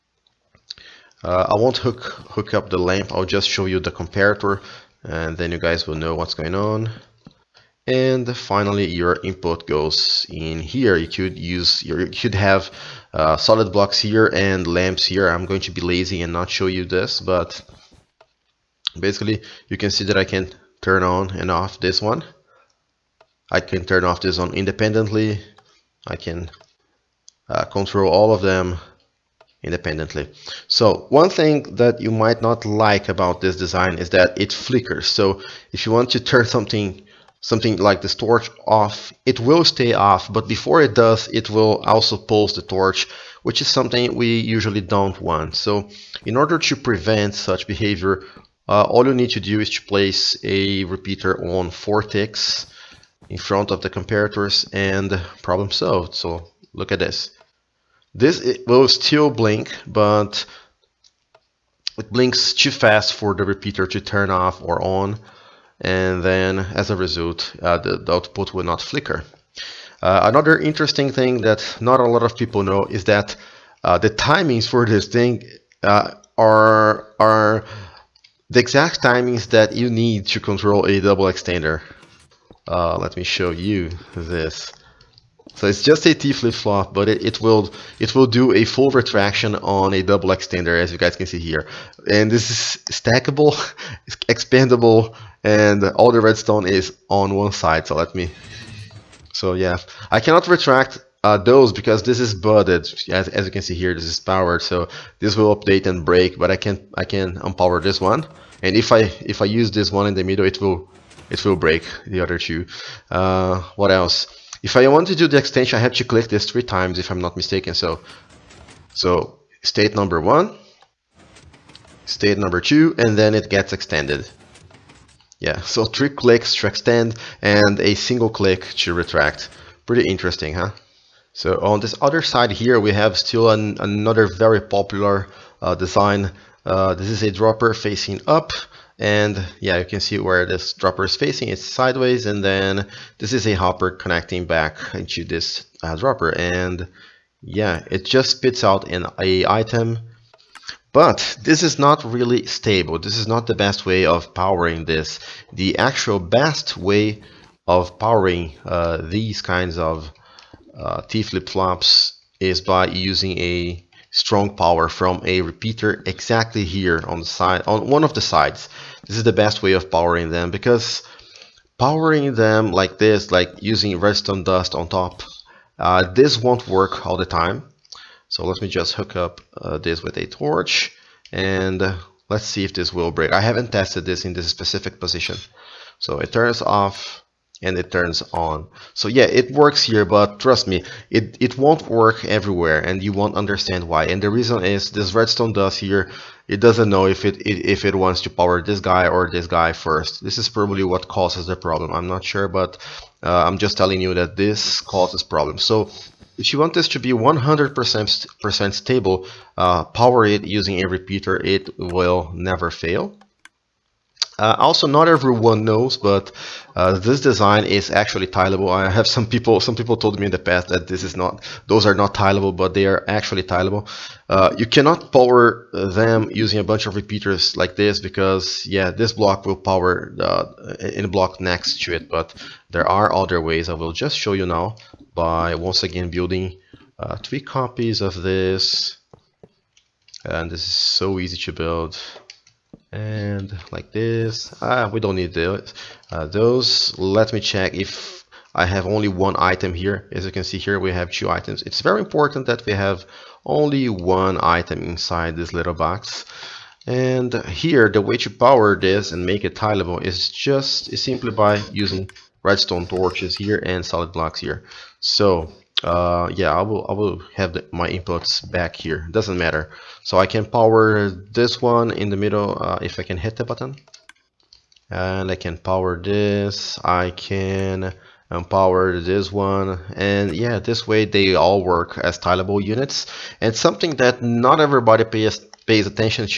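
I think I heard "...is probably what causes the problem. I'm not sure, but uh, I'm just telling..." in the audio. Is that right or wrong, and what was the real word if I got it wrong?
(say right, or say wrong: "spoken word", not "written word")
right.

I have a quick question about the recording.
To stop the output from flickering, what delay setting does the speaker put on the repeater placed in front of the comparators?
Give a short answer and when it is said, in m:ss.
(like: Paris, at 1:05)
4 ticks, at 0:51.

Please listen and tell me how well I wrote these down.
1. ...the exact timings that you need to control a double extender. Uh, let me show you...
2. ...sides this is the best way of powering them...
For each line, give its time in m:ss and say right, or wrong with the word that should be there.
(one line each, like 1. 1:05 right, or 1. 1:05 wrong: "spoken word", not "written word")
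1. 1:18 right
2. 2:48 right.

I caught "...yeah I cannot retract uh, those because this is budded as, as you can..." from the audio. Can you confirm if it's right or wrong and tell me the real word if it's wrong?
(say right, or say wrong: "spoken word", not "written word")
right.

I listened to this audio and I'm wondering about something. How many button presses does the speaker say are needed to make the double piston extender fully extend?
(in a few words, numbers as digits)
3.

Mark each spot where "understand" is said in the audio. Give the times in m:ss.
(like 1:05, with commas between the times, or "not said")
3:13.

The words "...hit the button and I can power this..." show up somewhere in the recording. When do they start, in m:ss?
4:33.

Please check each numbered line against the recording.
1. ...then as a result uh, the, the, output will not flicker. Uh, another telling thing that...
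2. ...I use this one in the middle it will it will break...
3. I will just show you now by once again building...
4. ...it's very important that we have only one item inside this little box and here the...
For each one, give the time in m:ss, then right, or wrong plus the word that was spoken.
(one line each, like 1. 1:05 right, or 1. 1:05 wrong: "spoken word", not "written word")
1. 1:06 wrong: "interesting", not "telling"
2. 1:49 right
3. 3:53 right
4. 4:11 right.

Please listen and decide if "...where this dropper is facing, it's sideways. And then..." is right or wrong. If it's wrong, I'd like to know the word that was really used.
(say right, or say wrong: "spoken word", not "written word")
right.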